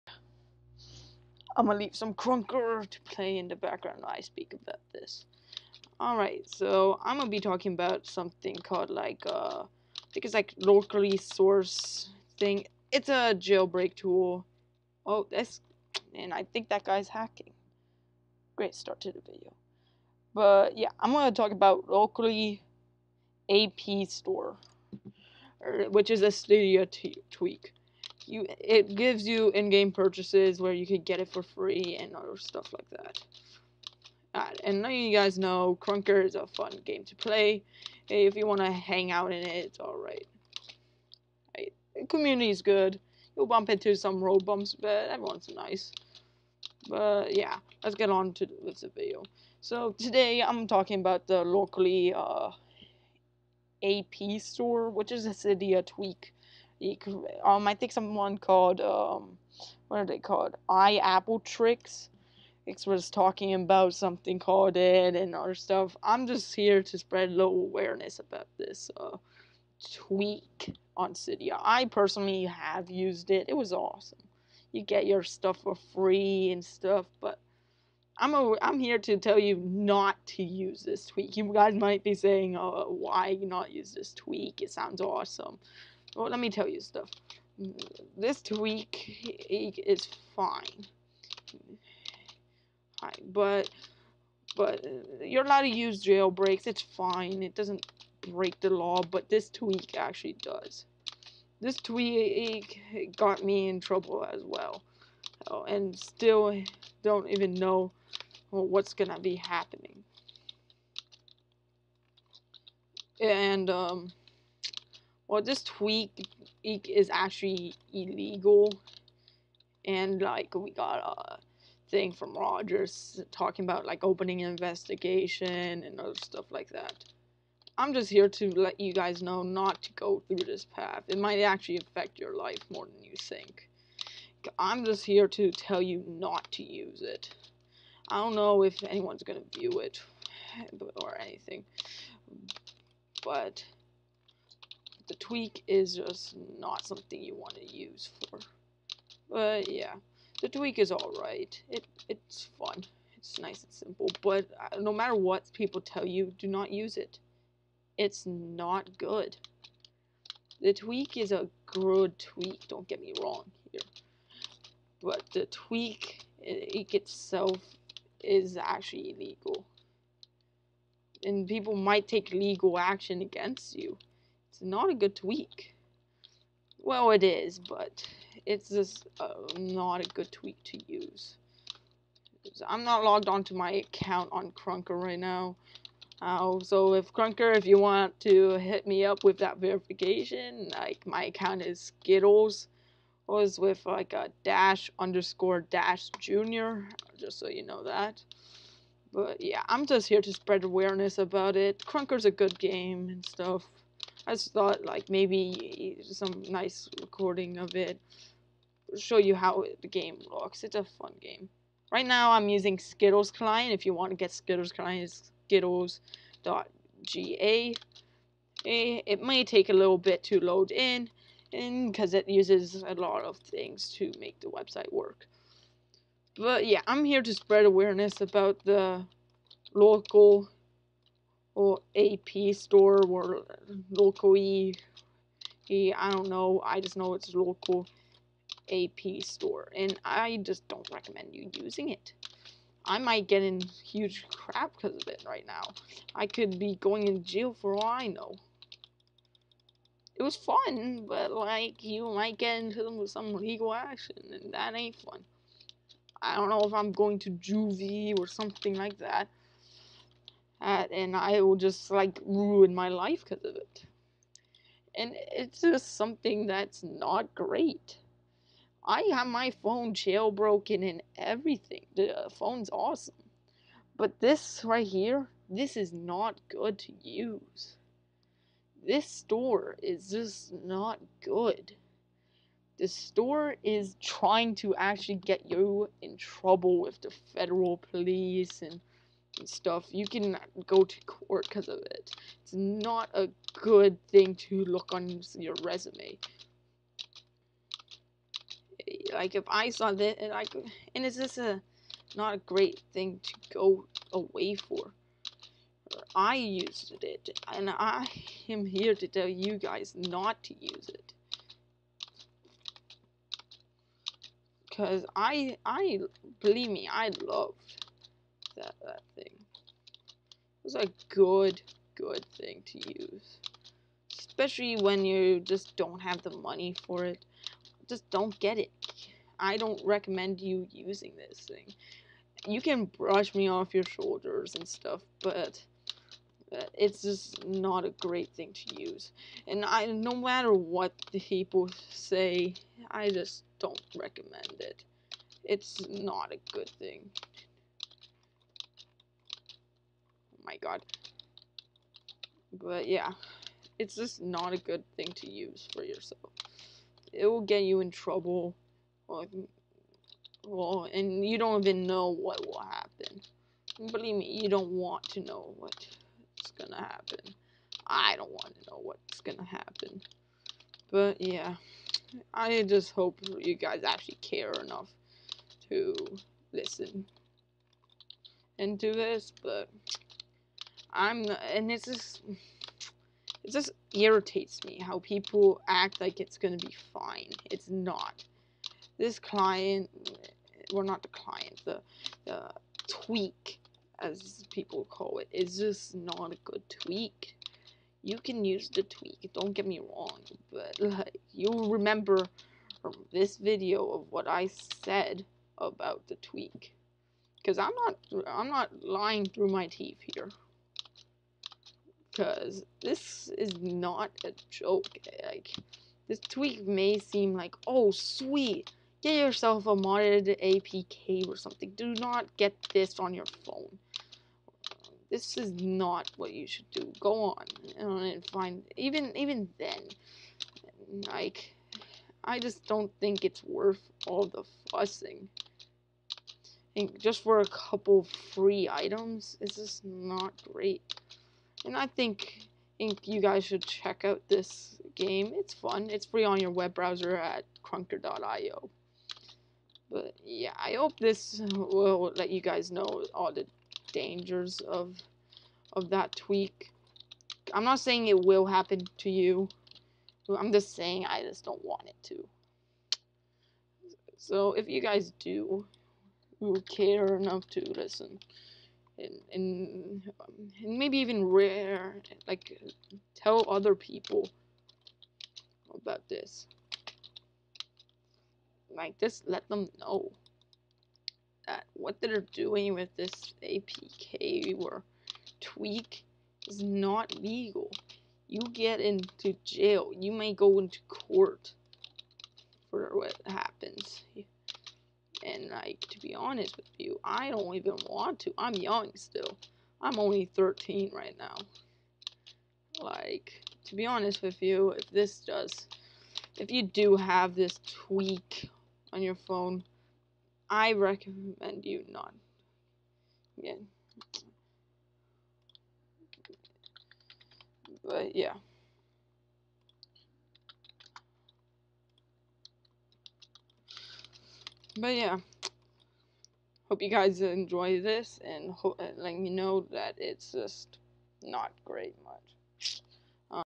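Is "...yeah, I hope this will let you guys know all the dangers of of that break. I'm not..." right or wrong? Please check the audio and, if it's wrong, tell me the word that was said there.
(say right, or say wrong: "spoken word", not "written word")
wrong: "tweak", not "break".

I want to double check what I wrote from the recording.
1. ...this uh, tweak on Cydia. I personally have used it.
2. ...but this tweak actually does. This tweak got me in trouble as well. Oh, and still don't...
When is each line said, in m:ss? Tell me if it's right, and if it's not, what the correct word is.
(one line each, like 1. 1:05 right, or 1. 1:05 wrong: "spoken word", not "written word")
1. 1:08 right
2. 1:39 right.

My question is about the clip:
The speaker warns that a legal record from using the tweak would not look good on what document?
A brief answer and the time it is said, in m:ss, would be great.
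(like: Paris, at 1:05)
Resume, at 4:55.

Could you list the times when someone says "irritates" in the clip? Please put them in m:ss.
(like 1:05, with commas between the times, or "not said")
6:23.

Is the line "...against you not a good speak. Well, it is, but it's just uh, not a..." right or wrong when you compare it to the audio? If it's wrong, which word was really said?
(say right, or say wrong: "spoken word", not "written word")
wrong: "tweak", not "speak".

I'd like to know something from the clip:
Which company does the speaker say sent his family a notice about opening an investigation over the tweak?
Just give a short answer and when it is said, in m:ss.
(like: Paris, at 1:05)
Rogers, at 2:02.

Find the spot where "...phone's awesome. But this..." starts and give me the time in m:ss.
4:32.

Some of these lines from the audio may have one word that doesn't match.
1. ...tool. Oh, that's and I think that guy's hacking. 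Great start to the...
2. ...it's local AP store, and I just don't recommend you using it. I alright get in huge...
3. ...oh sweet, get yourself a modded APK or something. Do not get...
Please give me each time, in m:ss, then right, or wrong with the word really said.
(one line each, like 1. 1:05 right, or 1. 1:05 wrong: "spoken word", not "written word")
1. 0:13 right
2. 3:57 wrong: "might", not "alright"
3. 6:57 right.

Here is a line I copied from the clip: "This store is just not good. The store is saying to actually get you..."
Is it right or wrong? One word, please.
wrong.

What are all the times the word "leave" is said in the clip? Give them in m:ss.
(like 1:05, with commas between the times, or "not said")
0:01.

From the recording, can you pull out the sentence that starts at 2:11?
It might actually affect your life more than you think.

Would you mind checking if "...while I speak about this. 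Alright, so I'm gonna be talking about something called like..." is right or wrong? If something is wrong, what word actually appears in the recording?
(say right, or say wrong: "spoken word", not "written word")
right.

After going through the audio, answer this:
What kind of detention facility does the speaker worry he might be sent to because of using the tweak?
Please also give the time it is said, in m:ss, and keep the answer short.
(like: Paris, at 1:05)
Juvie, at 4:17.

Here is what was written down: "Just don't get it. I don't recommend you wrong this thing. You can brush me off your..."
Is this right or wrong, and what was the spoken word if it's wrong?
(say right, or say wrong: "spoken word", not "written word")
wrong: "using", not "wrong".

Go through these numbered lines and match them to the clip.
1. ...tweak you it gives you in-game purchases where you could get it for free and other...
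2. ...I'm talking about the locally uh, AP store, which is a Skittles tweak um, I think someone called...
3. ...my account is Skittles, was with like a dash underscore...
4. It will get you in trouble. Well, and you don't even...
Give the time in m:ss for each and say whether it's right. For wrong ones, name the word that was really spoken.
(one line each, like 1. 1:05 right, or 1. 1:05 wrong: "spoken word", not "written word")
1. 0:27 right
2. 0:50 wrong: "Cydia", not "Skittles"
3. 3:11 right
4. 5:57 right.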